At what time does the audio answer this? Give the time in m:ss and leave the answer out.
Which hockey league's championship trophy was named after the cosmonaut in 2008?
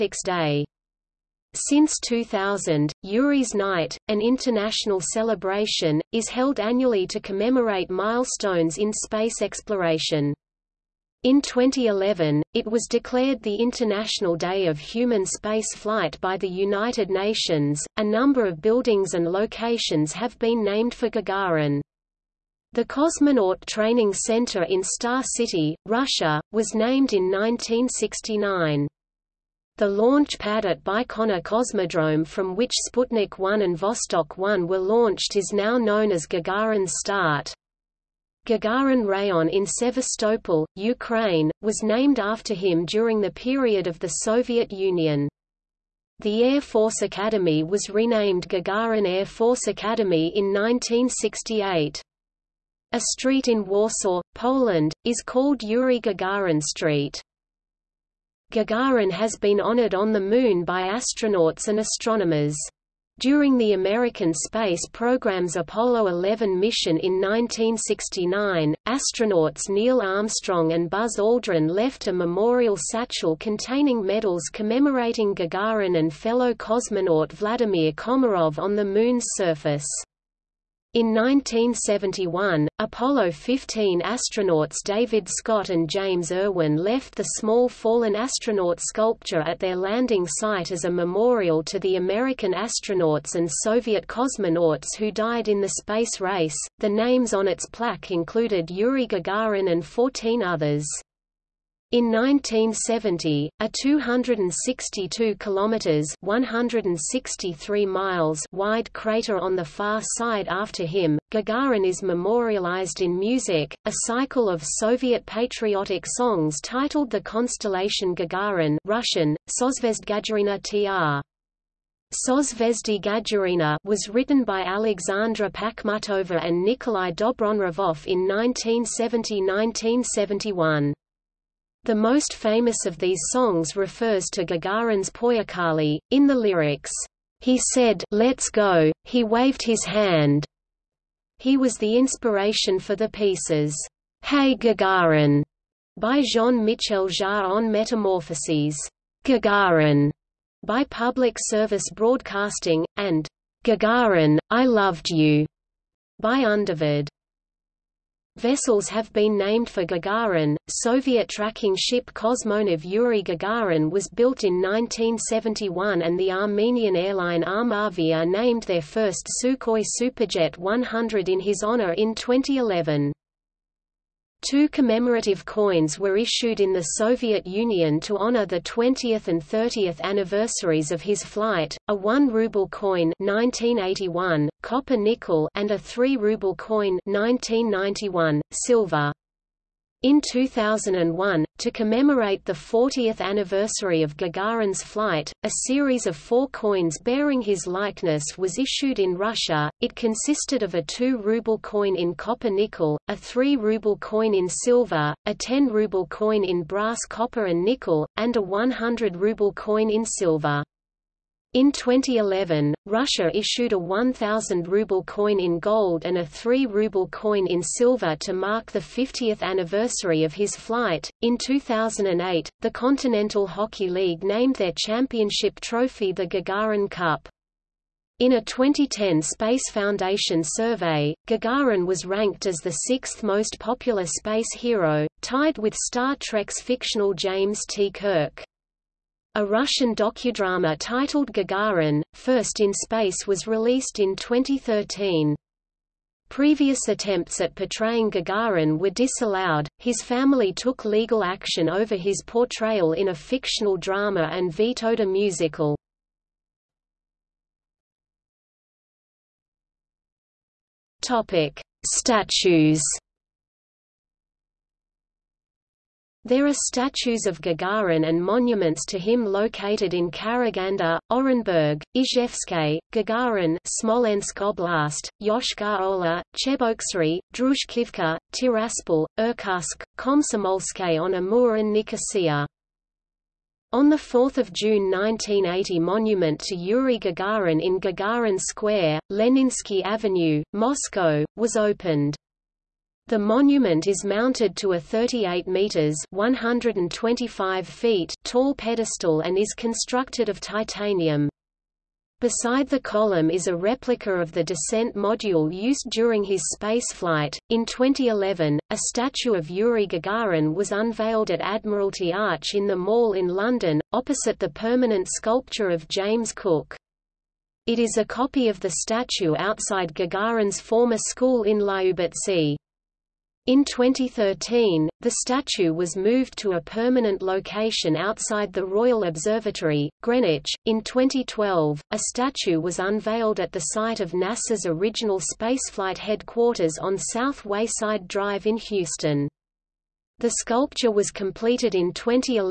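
3:42.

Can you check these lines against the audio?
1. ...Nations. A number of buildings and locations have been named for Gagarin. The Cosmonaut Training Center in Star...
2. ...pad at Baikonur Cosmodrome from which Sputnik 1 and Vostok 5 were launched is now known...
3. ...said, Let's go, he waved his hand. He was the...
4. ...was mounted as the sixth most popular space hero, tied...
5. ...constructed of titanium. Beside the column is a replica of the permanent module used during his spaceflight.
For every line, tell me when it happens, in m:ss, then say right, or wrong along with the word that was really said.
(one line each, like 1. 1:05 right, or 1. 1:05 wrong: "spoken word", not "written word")
1. 0:17 right
2. 0:30 wrong: "1", not "5"
3. 2:17 right
4. 3:51 wrong: "ranked", not "mounted"
5. 4:59 wrong: "descent", not "permanent".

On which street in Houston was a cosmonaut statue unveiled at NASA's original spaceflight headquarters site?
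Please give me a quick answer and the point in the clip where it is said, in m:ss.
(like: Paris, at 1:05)
South Wayside Drive, at 5:36.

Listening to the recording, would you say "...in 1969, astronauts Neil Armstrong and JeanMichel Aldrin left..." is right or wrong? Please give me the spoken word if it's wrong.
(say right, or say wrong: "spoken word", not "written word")
wrong: "Buzz", not "JeanMichel".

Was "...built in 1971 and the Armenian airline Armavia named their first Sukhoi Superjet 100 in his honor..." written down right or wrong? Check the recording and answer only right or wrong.
right.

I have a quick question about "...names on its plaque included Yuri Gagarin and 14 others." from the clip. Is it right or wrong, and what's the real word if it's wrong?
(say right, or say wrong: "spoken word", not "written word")
right.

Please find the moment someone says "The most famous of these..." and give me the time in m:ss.
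2:11.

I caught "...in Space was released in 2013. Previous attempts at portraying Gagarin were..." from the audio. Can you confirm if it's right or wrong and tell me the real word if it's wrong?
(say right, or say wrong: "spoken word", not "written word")
right.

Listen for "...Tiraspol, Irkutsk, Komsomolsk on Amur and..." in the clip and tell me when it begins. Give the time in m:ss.
4:38.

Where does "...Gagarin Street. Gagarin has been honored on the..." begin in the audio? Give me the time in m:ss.
0:55.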